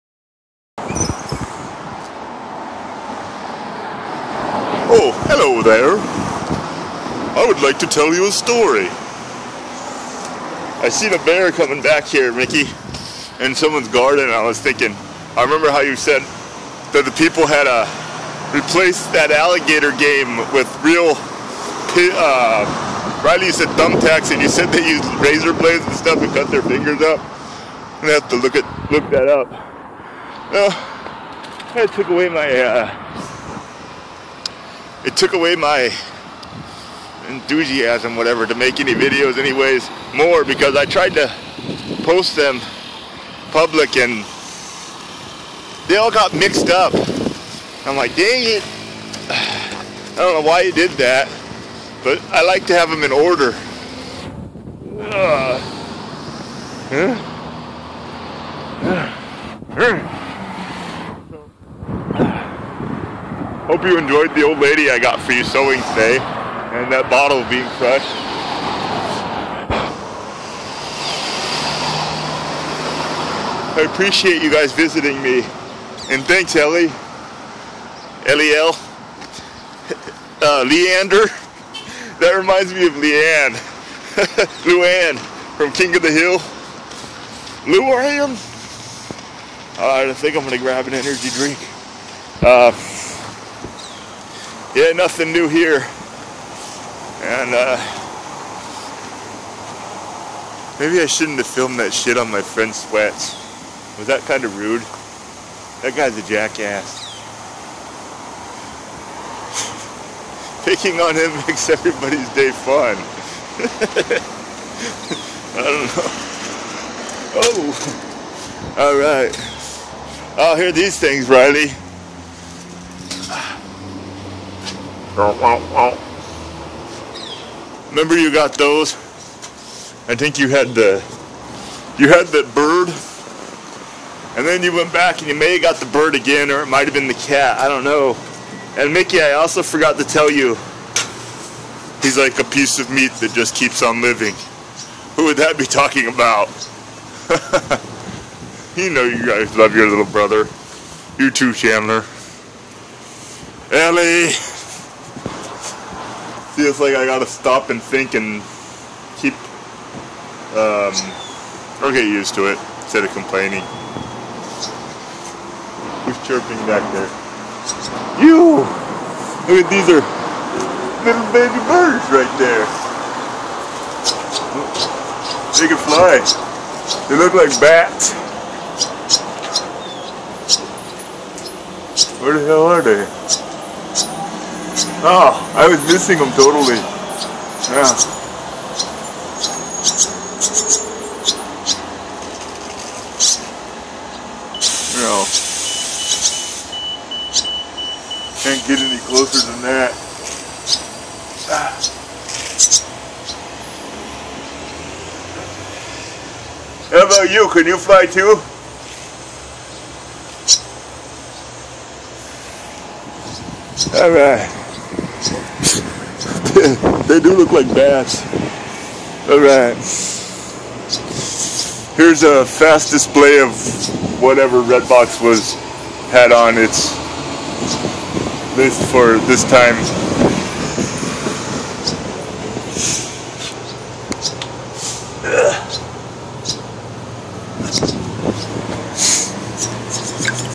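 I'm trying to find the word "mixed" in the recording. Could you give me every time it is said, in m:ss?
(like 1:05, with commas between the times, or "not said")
0:46.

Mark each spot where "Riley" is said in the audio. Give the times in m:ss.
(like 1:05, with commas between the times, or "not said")
0:23, 2:01.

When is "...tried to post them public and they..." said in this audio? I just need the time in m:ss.
0:40.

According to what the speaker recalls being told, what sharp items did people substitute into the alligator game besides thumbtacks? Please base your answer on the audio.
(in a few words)
razor blades.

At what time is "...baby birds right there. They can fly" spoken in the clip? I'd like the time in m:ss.
2:51.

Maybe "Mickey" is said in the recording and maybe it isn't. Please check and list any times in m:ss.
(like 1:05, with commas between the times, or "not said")
0:12, 2:18.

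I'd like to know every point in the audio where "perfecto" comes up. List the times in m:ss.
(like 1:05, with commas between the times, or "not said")
not said.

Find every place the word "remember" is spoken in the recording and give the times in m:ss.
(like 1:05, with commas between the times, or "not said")
0:15, 2:07.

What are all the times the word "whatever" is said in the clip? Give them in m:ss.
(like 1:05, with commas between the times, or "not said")
0:38, 3:44.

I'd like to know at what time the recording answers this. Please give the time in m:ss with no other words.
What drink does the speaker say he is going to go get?
1:30.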